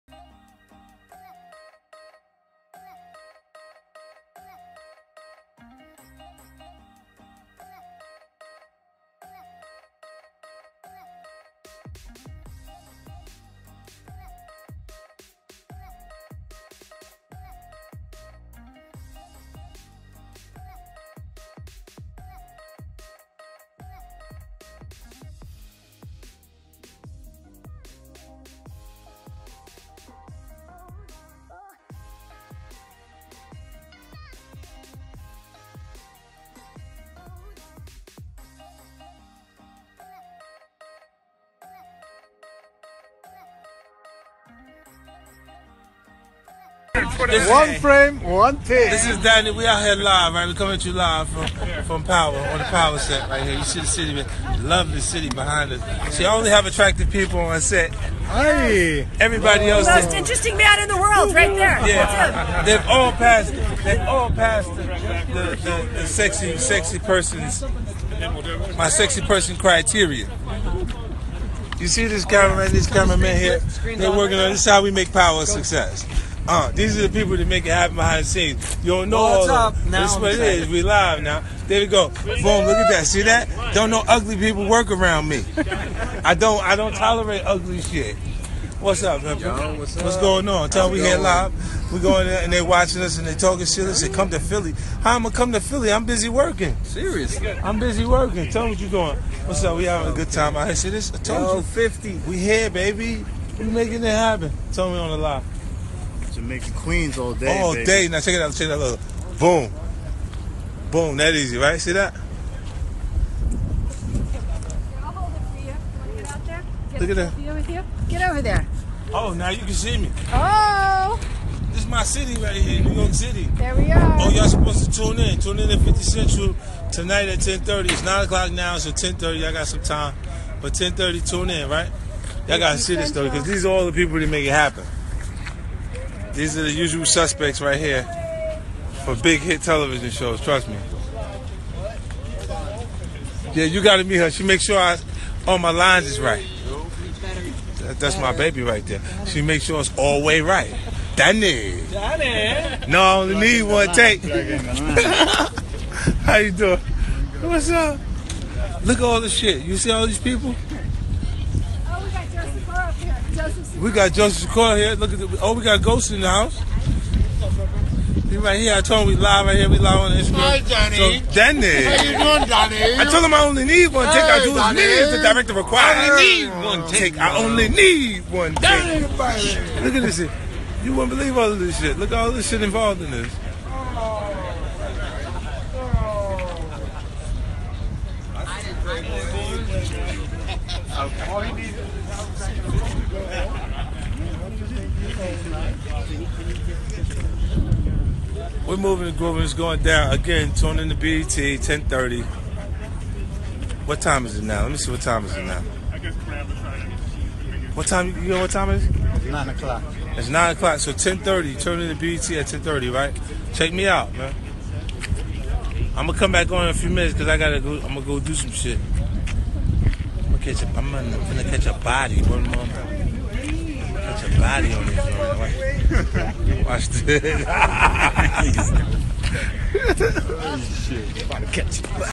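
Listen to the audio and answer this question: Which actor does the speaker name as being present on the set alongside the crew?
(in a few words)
Joseph Sikora.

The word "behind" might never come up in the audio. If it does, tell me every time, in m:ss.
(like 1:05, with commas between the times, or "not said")
0:55, 1:17.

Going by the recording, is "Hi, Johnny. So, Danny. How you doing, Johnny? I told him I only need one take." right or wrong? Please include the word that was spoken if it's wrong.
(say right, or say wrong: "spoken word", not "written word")
right.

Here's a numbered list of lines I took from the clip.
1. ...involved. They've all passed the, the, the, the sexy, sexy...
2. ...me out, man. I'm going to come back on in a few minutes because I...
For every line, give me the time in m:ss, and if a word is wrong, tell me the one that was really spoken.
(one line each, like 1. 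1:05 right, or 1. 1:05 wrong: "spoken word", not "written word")
1. 1:03 wrong: "passed", not "involved"
2. 3:33 right.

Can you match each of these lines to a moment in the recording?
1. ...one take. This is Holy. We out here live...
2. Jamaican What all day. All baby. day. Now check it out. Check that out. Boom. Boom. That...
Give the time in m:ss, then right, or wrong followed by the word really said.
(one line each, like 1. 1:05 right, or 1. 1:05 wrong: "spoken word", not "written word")
1. 0:48 wrong: "Danny", not "Holy"
2. 1:46 wrong: "Queens", not "What".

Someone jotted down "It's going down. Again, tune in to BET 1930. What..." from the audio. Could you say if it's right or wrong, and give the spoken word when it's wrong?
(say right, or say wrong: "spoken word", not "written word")
wrong: "1030", not "1930".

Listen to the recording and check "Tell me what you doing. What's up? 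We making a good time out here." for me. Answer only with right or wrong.
wrong.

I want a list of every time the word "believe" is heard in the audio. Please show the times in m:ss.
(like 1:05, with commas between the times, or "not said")
3:01.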